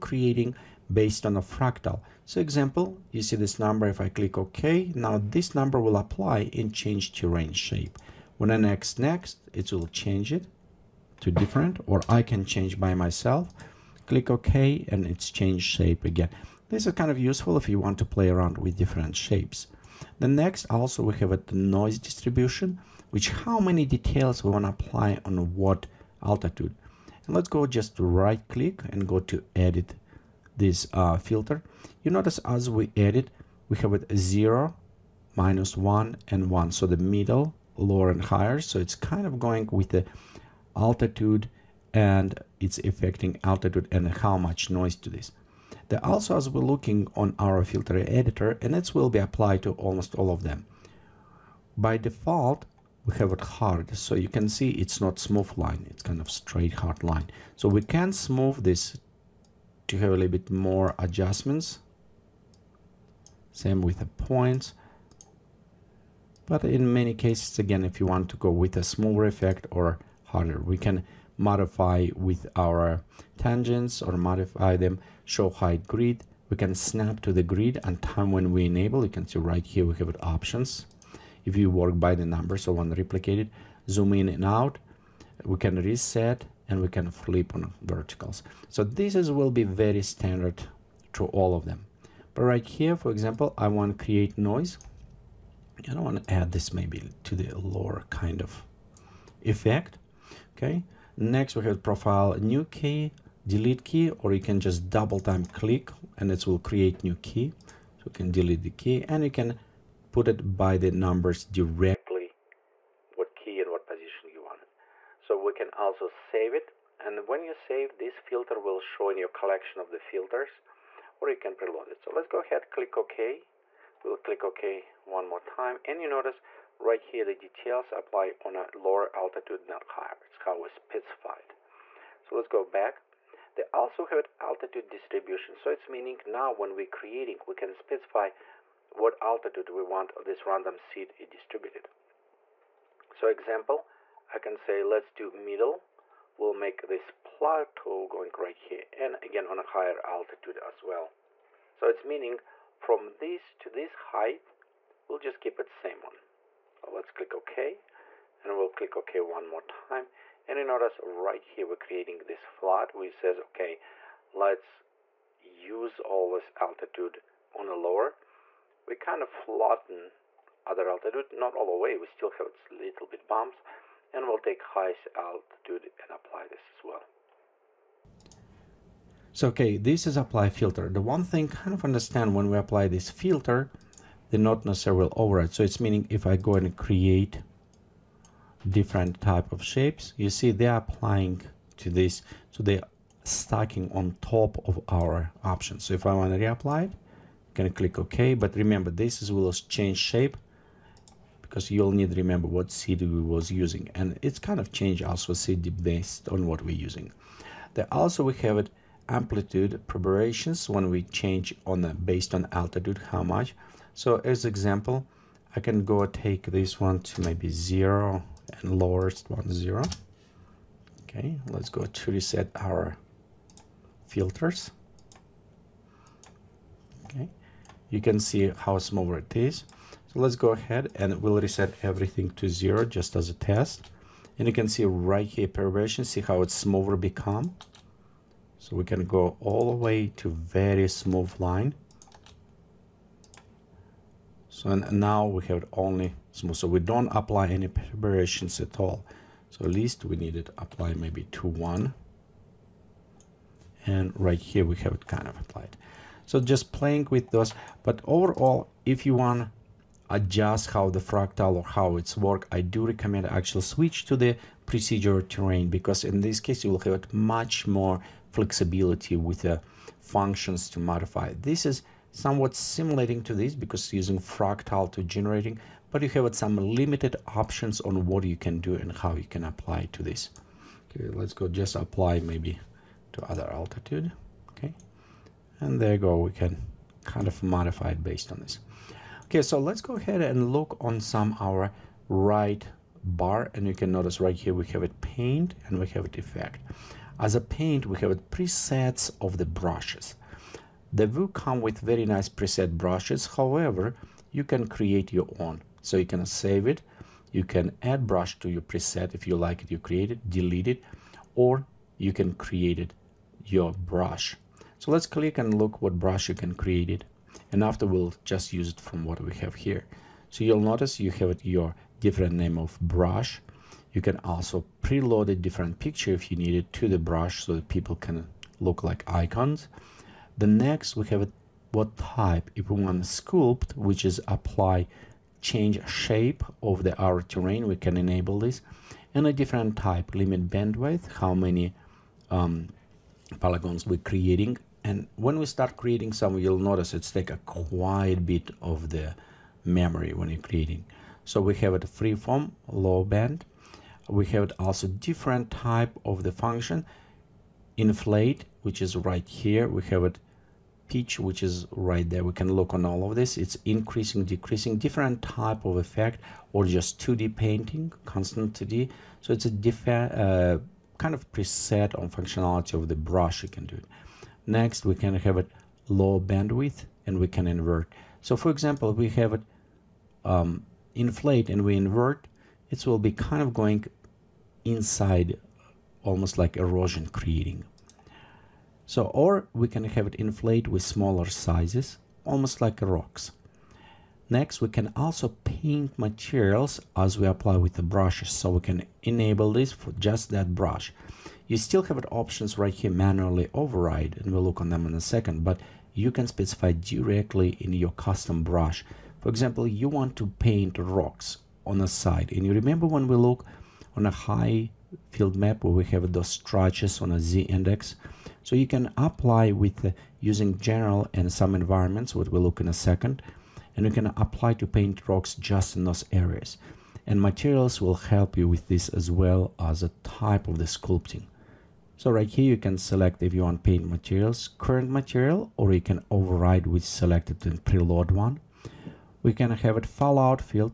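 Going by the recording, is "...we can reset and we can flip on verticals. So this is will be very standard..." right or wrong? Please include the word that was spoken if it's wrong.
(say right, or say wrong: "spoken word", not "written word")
right.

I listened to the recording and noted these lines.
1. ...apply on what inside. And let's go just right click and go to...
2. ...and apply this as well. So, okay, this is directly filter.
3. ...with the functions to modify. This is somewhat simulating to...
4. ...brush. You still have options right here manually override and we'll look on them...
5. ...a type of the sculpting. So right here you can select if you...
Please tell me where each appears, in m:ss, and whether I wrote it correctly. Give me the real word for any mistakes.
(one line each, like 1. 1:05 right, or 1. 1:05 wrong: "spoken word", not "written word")
1. 0:24 wrong: "altitude", not "inside"
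2. 2:56 wrong: "apply", not "directly"
3. 4:29 right
4. 6:40 right
5. 7:09 right.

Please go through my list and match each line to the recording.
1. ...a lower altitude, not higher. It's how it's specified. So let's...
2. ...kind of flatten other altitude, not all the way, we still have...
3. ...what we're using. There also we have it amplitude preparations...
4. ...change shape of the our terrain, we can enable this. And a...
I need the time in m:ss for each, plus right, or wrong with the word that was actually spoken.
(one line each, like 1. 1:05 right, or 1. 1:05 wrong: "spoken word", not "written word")
1. 2:08 right
2. 2:48 right
3. 3:26 right
4. 5:35 right.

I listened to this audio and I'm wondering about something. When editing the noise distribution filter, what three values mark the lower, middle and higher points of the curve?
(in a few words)
0, -1 and 1.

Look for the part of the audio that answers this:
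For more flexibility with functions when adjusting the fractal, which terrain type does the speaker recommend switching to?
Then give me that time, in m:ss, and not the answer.
4:24.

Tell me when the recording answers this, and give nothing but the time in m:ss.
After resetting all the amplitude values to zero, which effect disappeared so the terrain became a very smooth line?
3:55.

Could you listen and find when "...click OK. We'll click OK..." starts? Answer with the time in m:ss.
2:02.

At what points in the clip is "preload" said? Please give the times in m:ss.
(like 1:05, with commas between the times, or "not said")
2:01, 5:24, 7:17.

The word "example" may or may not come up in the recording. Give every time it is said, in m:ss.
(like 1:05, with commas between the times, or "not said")
0:02, 1:33, 2:23, 3:34, 6:18, 6:49.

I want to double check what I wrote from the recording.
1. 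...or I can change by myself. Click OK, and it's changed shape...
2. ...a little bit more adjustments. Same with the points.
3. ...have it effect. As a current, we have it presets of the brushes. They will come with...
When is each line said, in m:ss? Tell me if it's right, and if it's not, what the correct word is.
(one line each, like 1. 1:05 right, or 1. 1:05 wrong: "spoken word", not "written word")
1. 0:11 right
2. 1:00 right
3. 4:55 wrong: "paint", not "current".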